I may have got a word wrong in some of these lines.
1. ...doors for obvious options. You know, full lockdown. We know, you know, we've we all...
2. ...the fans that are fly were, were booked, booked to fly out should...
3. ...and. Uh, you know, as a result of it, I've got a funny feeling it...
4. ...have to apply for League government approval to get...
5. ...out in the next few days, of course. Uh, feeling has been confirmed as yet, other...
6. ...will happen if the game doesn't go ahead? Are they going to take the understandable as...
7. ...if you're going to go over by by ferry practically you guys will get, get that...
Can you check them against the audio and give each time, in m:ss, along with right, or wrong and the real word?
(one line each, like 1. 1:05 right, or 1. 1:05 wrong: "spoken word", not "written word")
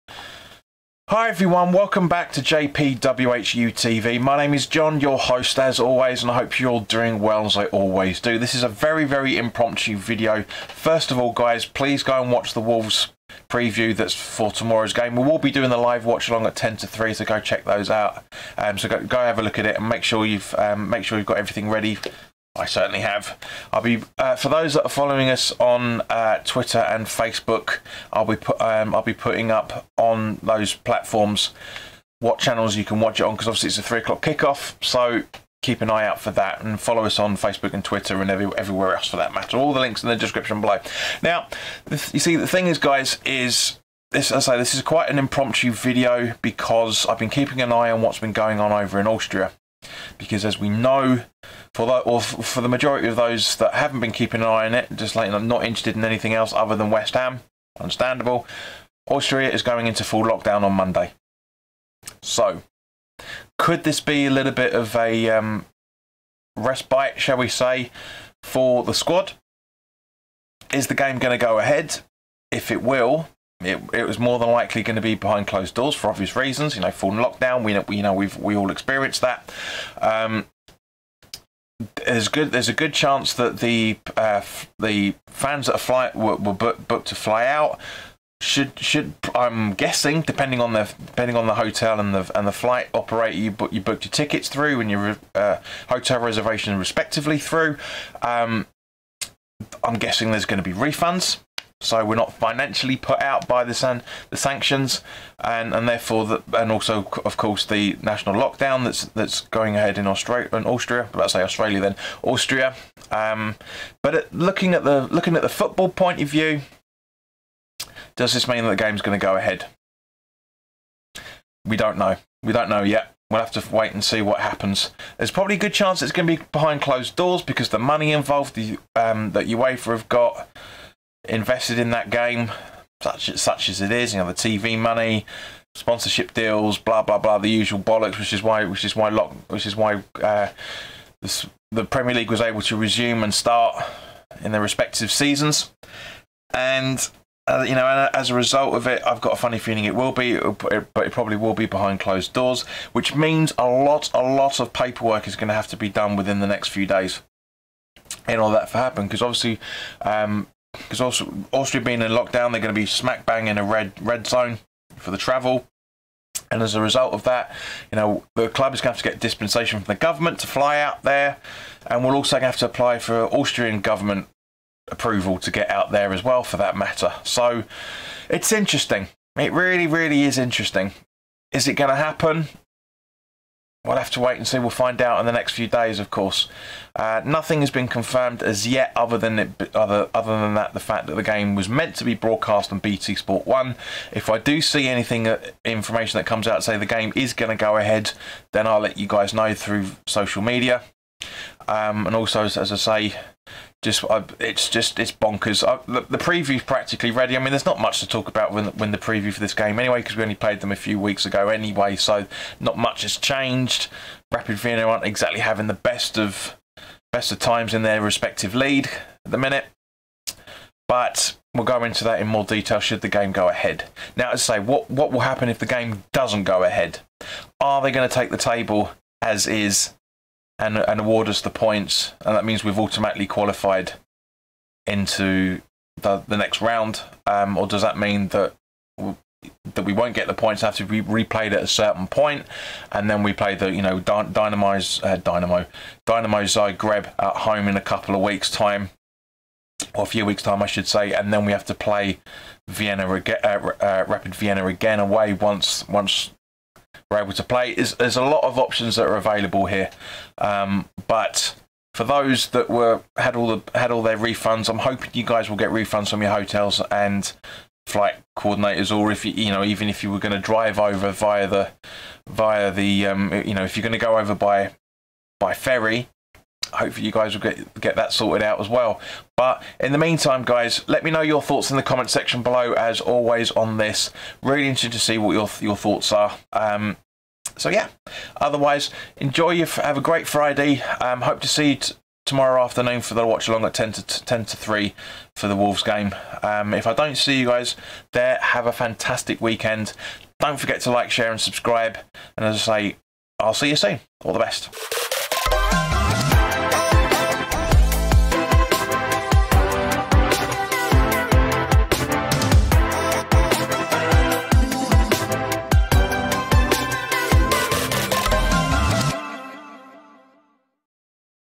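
1. 1:15 wrong: "reasons", not "options"
2. 1:24 right
3. 2:26 right
4. 2:52 wrong: "Austrian", not "League"
5. 3:05 wrong: "nothing", not "feeling"
6. 3:45 wrong: "table", not "understandable"
7. 4:33 wrong: "hopefully", not "practically".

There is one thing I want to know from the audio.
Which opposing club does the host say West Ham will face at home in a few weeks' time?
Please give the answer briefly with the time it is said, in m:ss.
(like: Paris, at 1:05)
Dynamo Zagreb, at 4:06.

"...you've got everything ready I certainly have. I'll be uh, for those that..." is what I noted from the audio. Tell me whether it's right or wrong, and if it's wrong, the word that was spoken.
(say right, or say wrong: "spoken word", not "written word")
right.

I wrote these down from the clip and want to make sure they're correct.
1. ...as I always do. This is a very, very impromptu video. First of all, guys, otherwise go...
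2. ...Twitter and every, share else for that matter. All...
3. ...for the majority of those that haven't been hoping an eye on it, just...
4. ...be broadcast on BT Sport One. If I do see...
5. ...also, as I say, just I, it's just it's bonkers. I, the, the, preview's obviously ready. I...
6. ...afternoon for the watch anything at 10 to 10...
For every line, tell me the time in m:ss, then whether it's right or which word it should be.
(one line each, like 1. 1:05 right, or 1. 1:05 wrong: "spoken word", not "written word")
1. 0:07 wrong: "please", not "otherwise"
2. 0:37 wrong: "everywhere", not "share"
3. 0:52 wrong: "keeping", not "hoping"
4. 3:12 right
5. 3:22 wrong: "practically", not "obviously"
6. 4:52 wrong: "along", not "anything".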